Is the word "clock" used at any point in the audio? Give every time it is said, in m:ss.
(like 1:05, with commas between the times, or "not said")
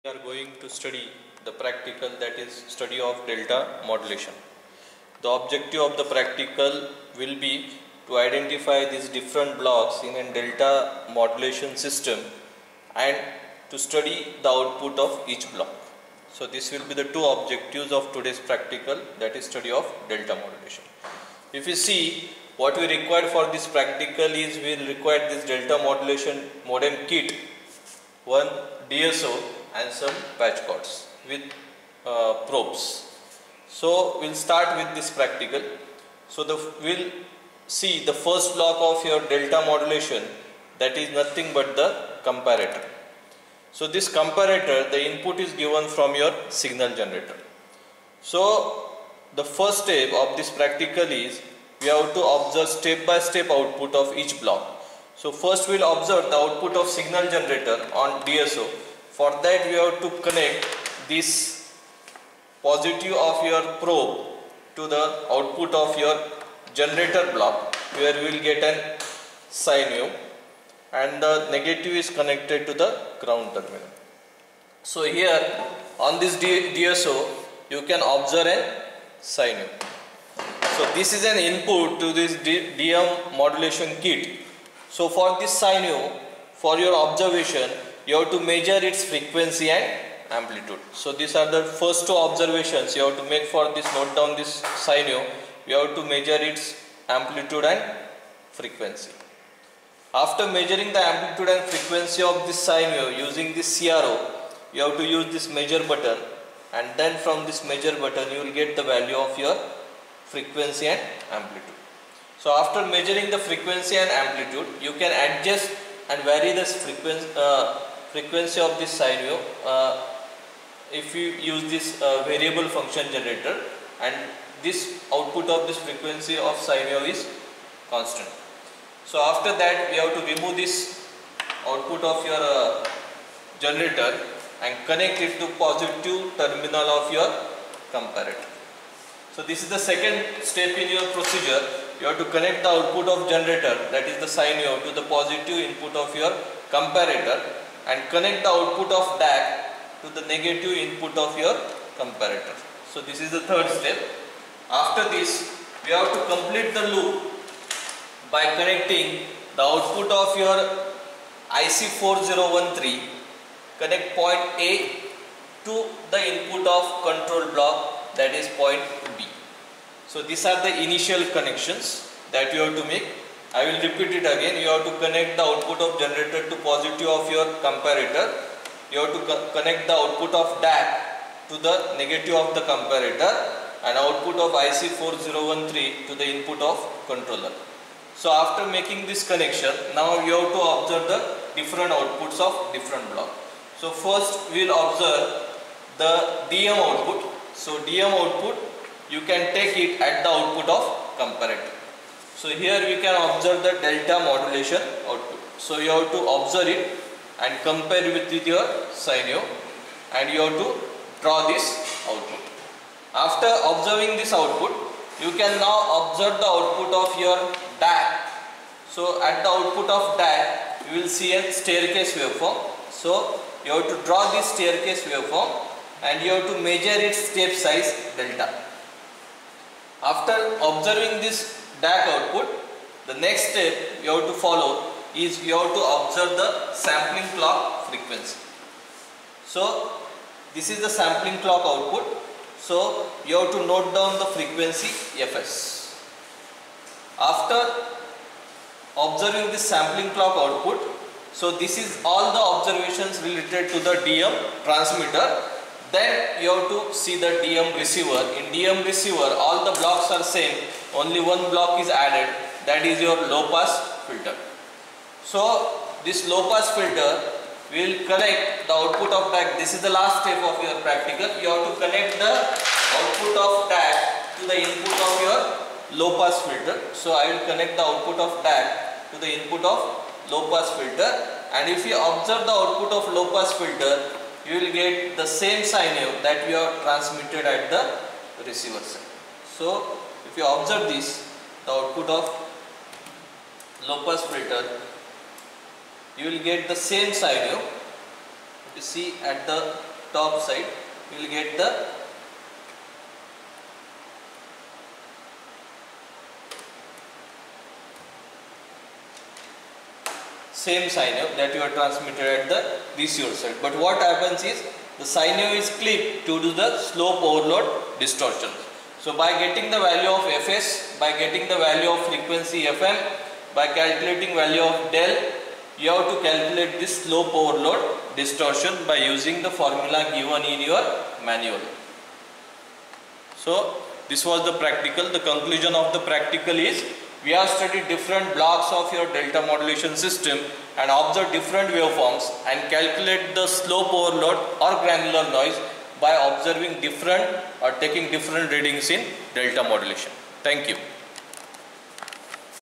3:57, 4:01, 4:10.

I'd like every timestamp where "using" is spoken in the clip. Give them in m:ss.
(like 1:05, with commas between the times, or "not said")
1:43, 5:28.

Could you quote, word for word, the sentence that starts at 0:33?
So we'll start with this practical.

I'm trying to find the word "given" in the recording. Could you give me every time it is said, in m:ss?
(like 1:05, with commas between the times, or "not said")
0:45, 5:30.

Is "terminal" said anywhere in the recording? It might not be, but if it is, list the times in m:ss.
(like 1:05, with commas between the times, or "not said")
1:13, 2:16.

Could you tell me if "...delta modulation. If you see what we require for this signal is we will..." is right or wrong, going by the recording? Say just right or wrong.
wrong.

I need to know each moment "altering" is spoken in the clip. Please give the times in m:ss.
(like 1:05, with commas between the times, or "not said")
not said.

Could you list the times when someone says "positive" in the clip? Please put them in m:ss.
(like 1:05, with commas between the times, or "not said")
1:02, 2:15, 2:25, 2:56.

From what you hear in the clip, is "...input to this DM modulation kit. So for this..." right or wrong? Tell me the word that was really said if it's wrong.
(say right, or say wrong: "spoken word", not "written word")
right.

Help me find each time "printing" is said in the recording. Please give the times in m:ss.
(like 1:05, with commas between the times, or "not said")
not said.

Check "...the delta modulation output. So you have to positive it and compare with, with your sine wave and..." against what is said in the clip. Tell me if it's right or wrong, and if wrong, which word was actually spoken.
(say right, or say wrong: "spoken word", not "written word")
wrong: "observe", not "positive".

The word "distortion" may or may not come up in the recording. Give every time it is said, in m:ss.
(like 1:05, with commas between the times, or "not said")
5:17, 5:28.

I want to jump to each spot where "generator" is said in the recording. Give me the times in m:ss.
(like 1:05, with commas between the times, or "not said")
0:46, 0:57, 1:06, 2:03, 2:13, 2:23, 2:55.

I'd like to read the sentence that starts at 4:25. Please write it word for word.
So this low pass filter will connect the output of DAC.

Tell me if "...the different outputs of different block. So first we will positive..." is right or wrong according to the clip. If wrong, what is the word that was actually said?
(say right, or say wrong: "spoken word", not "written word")
wrong: "observe", not "positive".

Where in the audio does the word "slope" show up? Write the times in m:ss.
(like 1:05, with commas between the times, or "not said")
5:16, 5:27, 5:43.